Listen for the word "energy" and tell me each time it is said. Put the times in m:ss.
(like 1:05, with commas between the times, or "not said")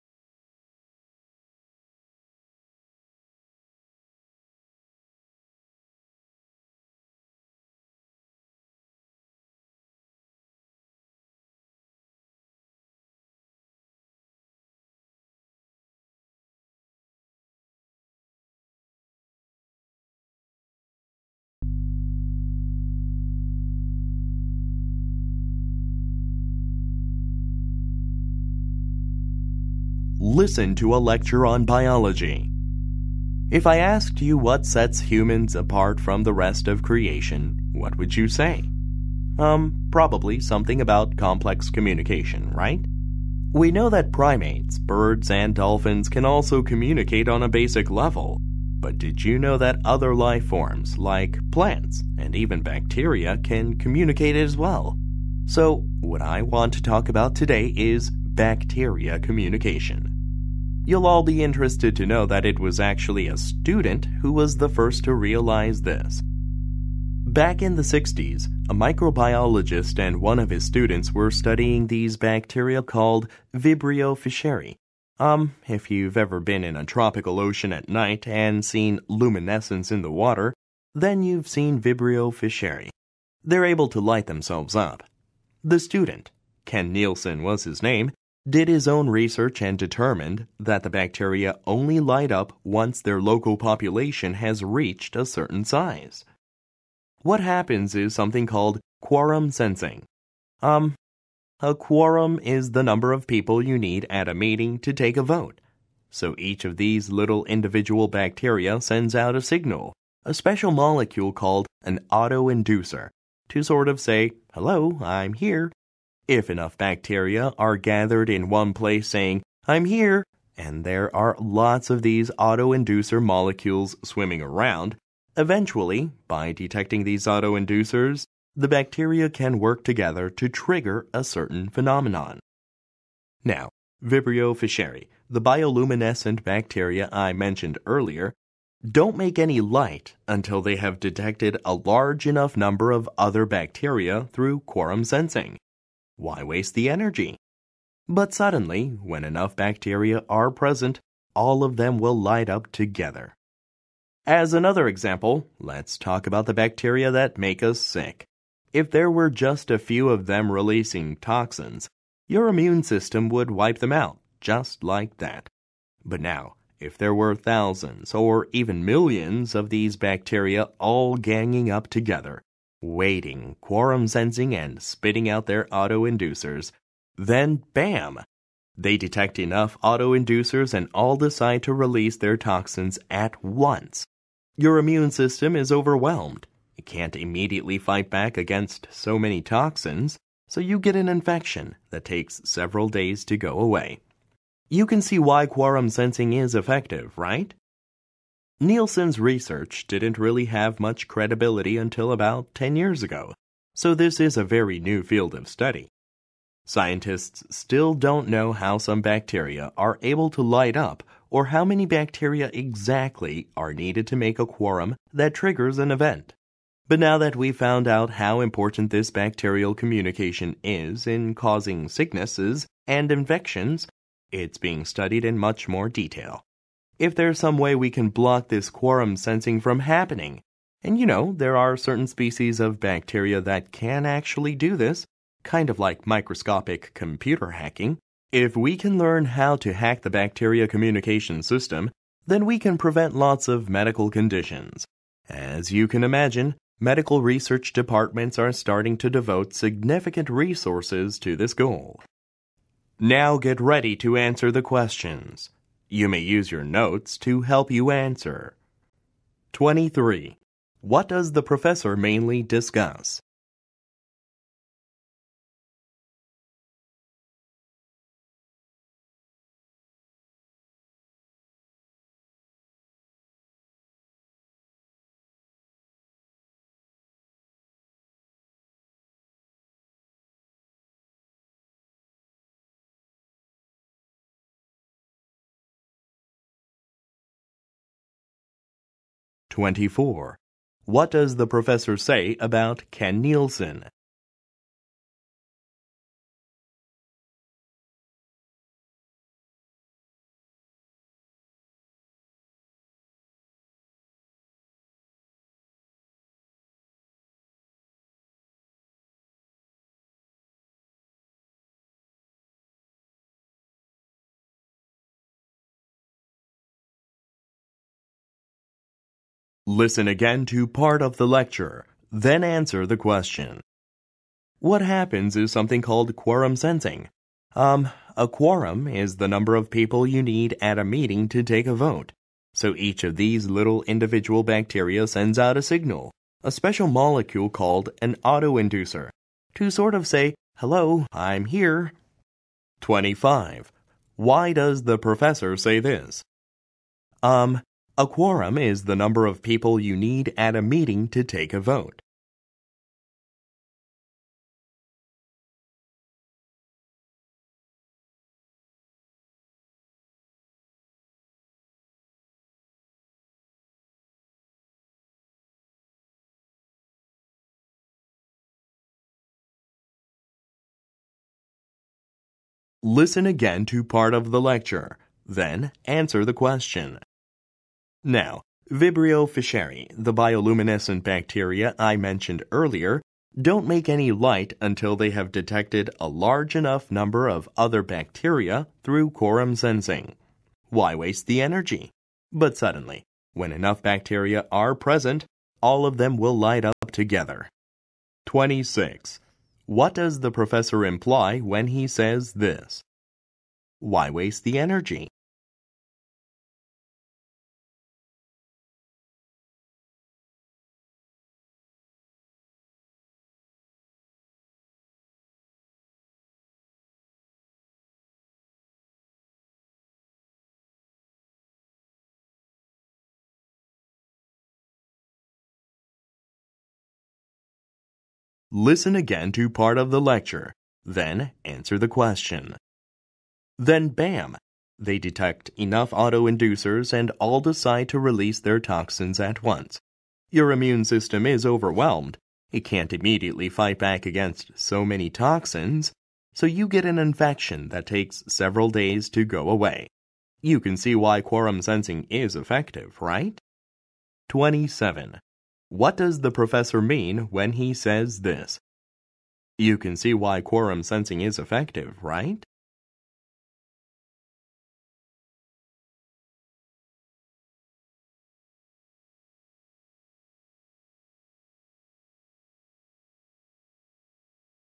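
2:26, 6:31, 6:44.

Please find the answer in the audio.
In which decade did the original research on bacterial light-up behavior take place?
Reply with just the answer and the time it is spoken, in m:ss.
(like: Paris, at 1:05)
the 60s, at 1:07.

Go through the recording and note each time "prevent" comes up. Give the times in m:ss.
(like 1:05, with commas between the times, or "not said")
4:02.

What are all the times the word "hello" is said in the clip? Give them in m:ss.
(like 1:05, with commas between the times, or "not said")
1:54, 5:40.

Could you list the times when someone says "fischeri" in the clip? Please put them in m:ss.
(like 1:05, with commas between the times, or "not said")
1:14, 1:22, 2:14, 6:19.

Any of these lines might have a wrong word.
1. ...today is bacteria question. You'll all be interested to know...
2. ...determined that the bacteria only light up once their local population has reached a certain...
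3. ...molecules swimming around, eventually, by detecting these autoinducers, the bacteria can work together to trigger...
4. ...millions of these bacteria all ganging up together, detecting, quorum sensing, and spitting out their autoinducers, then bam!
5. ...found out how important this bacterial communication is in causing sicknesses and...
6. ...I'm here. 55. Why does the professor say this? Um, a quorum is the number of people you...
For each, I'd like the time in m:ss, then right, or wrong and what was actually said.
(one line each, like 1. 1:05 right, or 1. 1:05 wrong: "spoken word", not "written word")
1. 0:57 wrong: "communication", not "question"
2. 1:29 right
3. 2:03 right
4. 2:48 wrong: "waiting", not "detecting"
5. 3:37 right
6. 5:41 wrong: "25", not "55".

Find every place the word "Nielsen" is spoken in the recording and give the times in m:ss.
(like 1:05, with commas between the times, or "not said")
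1:26, 3:18, 4:53.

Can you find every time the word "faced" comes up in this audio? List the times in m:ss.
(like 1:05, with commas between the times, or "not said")
not said.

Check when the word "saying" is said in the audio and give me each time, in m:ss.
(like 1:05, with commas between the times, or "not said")
1:59.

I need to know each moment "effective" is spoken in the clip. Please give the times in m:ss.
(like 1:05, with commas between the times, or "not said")
3:16, 7:32, 7:41.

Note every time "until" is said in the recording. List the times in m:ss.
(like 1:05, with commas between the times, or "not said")
2:20, 3:21, 6:24.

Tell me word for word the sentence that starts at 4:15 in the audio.
You may use your notes to help you answer.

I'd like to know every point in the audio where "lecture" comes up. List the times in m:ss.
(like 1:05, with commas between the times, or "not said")
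0:31, 5:21, 6:14, 7:10.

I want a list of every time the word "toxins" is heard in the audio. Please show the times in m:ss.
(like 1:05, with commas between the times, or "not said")
2:41, 3:02, 3:09, 7:18, 7:25.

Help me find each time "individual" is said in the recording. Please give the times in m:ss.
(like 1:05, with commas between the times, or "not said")
1:47, 5:33.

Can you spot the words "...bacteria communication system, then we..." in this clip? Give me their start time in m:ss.
4:00.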